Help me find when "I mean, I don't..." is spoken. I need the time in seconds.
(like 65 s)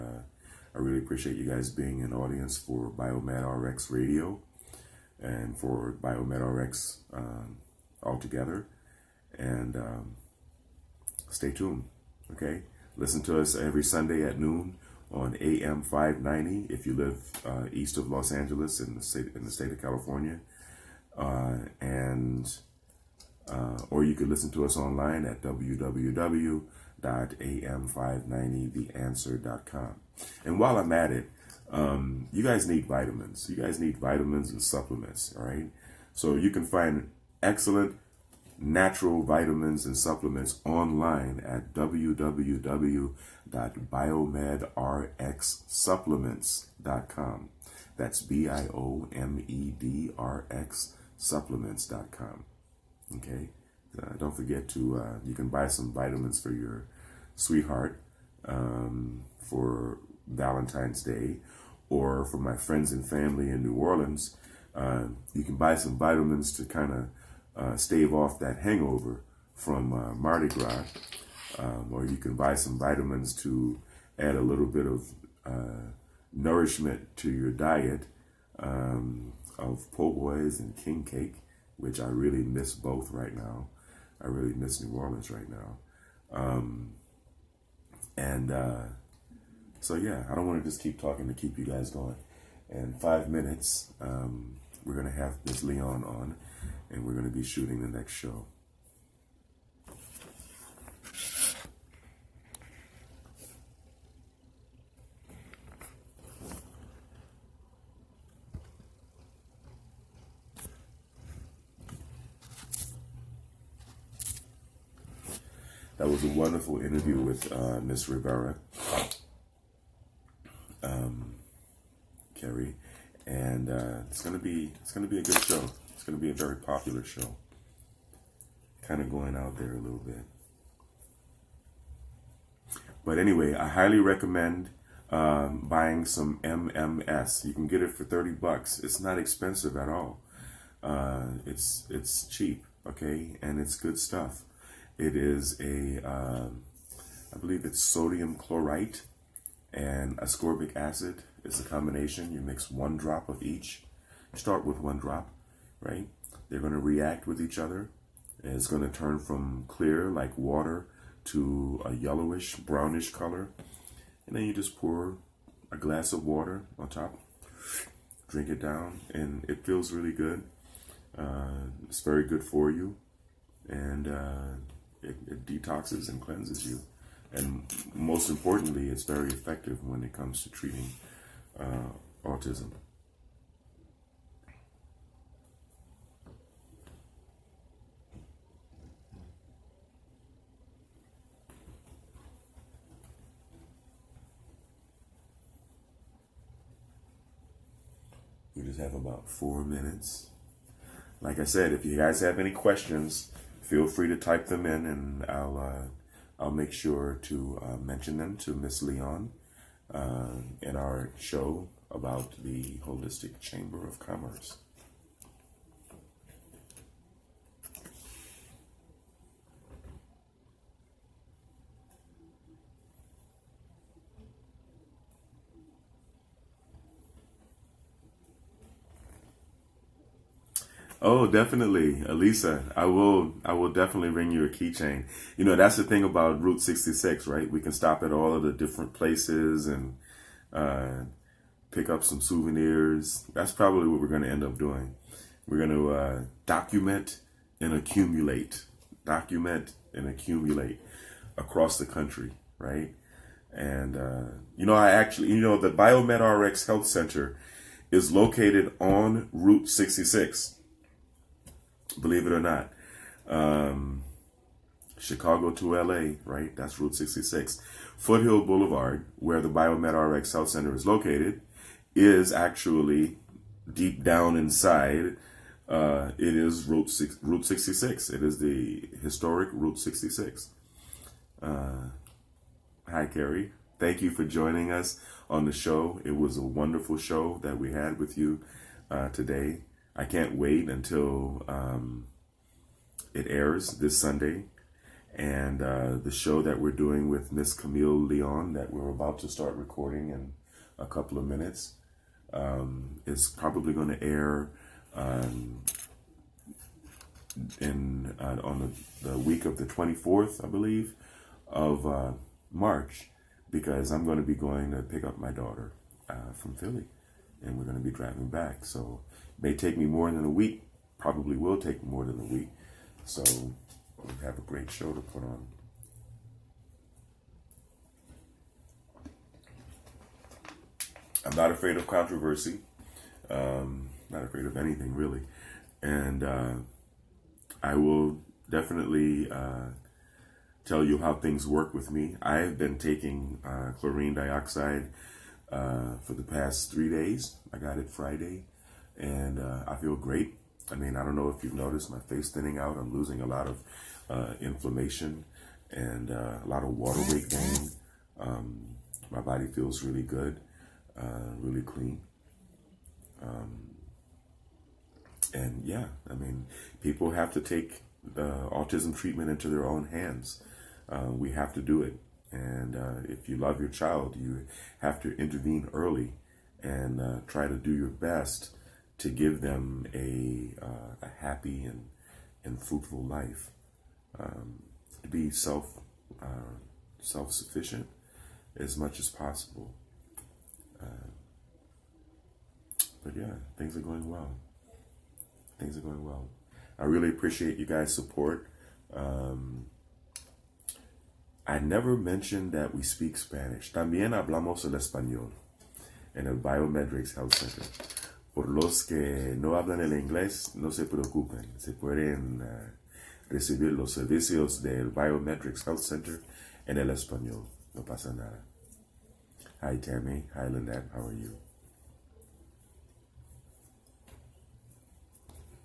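350 s.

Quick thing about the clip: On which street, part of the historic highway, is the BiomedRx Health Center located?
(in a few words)
Foothill Boulevard.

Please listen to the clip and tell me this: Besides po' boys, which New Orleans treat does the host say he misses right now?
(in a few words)
king cake.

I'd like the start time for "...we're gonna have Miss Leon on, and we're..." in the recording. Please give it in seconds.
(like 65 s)
94 s.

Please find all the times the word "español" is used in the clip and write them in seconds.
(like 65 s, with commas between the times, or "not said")
404 s, 416 s.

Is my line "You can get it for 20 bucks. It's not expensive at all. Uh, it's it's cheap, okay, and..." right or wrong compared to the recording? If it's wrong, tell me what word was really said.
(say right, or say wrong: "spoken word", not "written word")
wrong: "30", not "20".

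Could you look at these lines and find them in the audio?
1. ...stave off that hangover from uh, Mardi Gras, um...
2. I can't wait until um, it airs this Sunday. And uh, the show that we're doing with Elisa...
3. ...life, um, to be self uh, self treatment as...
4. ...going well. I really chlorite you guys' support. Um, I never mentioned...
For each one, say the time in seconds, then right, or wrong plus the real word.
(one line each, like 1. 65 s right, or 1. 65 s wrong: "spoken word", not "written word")
1. 67 s right
2. 289 s wrong: "Miss", not "Elisa"
3. 383 s wrong: "sufficient", not "treatment"
4. 395 s wrong: "appreciate", not "chlorite".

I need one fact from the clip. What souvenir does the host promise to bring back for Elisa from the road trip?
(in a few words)
keychain.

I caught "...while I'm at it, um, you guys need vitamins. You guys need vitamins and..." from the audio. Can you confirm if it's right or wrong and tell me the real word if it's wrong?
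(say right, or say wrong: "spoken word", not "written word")
right.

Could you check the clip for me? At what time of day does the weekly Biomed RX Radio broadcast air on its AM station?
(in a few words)
noon.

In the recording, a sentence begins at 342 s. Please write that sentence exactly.
I have been taking uh, chlorine dioxide uh, for the past three days.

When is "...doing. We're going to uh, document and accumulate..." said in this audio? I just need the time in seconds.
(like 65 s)
244 s.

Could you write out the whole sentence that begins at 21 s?
Uh, and uh, or you could listen to us online at www.am590theanswer.com.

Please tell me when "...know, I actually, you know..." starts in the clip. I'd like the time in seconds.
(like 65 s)
254 s.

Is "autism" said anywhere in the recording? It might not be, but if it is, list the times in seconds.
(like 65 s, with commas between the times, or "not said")
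182 s, 368 s.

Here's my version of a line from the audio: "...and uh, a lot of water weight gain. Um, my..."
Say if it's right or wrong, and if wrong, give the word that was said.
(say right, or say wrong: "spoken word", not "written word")
right.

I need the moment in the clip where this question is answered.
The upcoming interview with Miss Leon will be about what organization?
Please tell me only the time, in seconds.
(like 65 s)
212 s.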